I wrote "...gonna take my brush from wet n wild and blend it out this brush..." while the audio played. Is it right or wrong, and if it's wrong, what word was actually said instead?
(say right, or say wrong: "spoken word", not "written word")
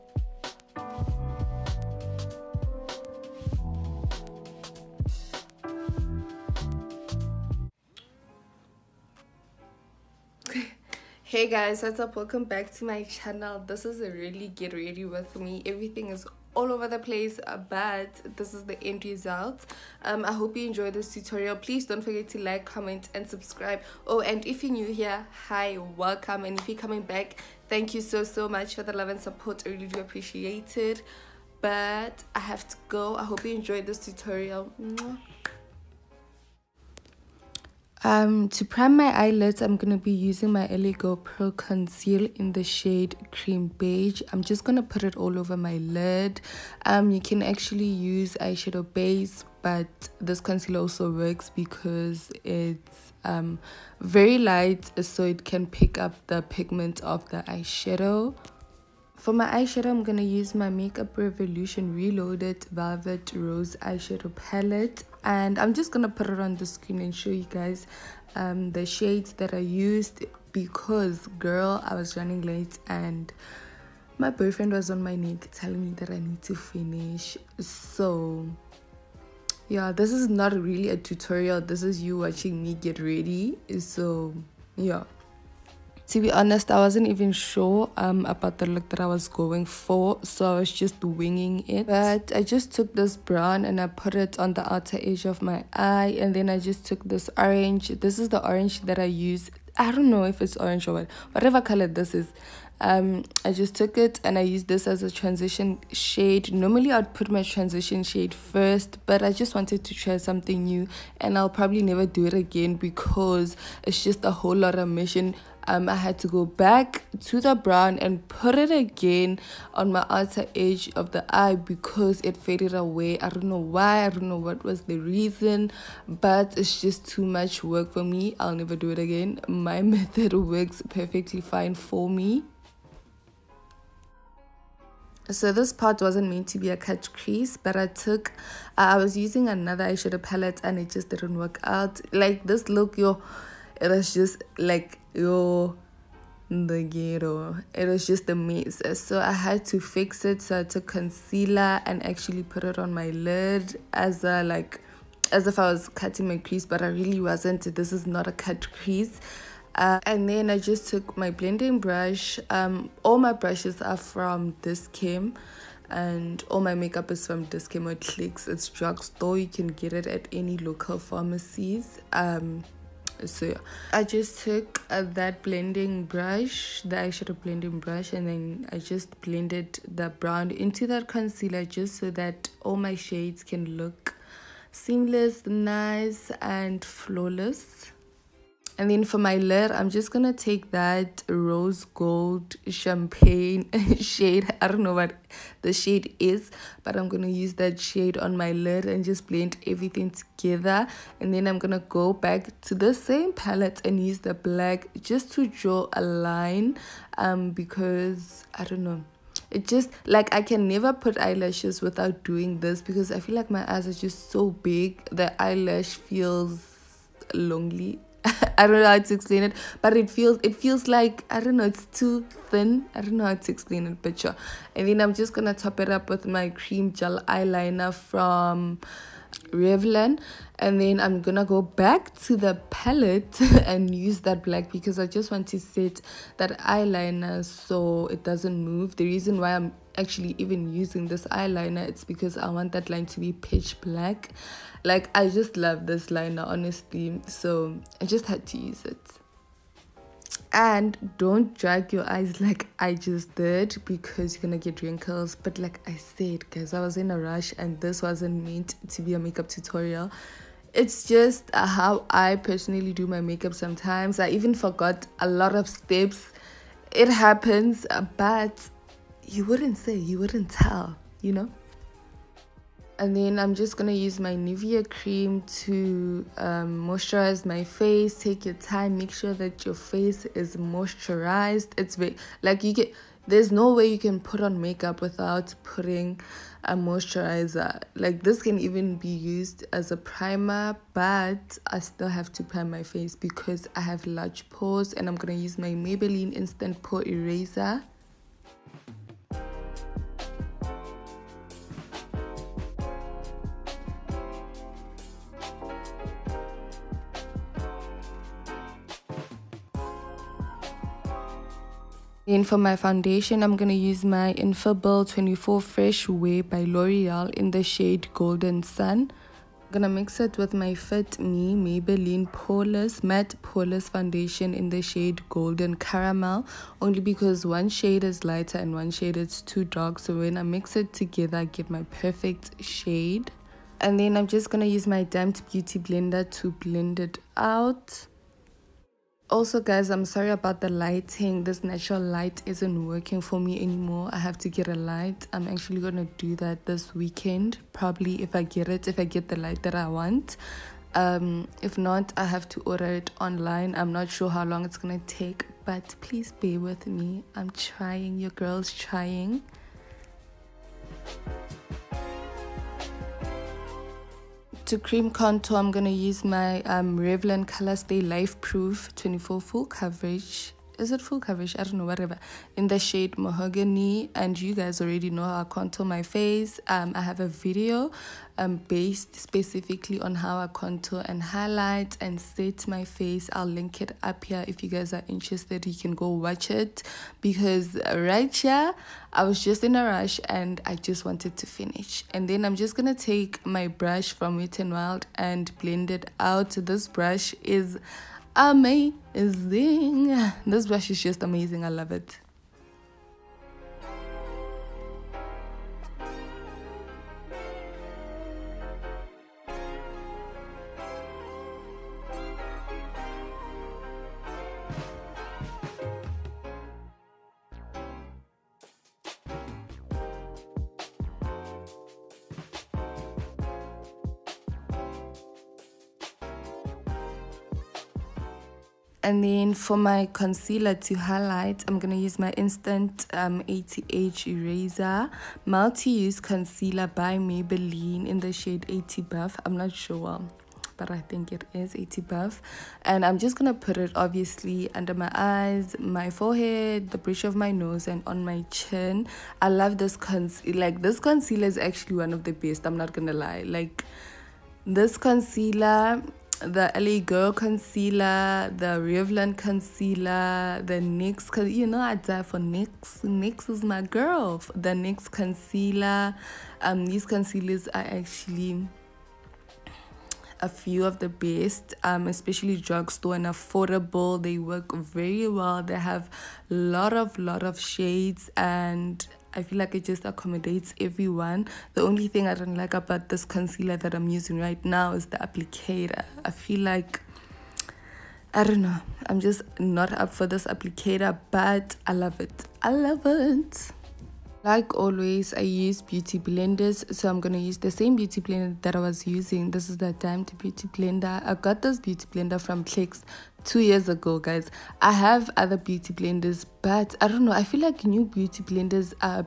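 right.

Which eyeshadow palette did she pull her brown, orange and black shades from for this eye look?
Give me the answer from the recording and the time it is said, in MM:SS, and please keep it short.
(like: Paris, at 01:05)
Makeup Revolution Reloaded Velvet Rose, at 01:00.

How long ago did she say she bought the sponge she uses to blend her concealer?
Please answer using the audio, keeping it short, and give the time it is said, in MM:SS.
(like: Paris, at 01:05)
2 years, at 08:23.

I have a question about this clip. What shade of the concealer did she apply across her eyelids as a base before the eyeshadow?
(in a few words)
Cream Beige.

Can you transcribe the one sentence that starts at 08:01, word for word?
The only thing I don't like about this concealer that I'm using right now is the applicator.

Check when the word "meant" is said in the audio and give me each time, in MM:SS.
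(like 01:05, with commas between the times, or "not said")
02:16, 04:18.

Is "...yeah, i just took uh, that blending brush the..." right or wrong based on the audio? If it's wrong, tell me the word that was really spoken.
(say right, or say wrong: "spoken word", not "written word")
right.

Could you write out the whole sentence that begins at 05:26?
Only because one shade is lighter and one shade is too dark.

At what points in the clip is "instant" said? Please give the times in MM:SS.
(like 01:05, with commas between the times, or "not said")
04:56, 07:12.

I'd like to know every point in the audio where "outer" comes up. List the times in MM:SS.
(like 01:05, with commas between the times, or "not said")
01:34, 02:00.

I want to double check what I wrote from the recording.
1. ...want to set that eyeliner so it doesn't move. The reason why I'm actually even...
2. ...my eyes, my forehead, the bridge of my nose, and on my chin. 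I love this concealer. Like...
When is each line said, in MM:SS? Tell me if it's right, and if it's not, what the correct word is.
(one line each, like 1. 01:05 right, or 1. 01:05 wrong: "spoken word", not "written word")
1. 03:55 right
2. 07:24 right.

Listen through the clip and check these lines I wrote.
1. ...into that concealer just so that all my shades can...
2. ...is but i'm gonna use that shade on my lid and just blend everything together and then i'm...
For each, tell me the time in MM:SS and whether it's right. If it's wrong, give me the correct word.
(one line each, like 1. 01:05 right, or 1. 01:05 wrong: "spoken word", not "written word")
1. 03:00 right
2. 03:16 right.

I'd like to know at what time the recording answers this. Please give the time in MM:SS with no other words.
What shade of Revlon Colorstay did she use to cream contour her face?
06:13.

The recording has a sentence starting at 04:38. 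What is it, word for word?
Take your time, make sure that your face is moisturized.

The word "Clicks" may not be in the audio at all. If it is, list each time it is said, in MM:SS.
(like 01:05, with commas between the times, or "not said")
02:47, 08:22.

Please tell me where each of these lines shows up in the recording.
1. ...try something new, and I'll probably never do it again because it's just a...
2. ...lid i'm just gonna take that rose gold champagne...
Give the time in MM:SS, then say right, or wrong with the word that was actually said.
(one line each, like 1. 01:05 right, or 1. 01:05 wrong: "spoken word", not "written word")
1. 01:49 right
2. 03:09 right.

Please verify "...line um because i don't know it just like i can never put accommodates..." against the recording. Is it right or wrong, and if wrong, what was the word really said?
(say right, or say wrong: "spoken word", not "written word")
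wrong: "eyelashes", not "accommodates".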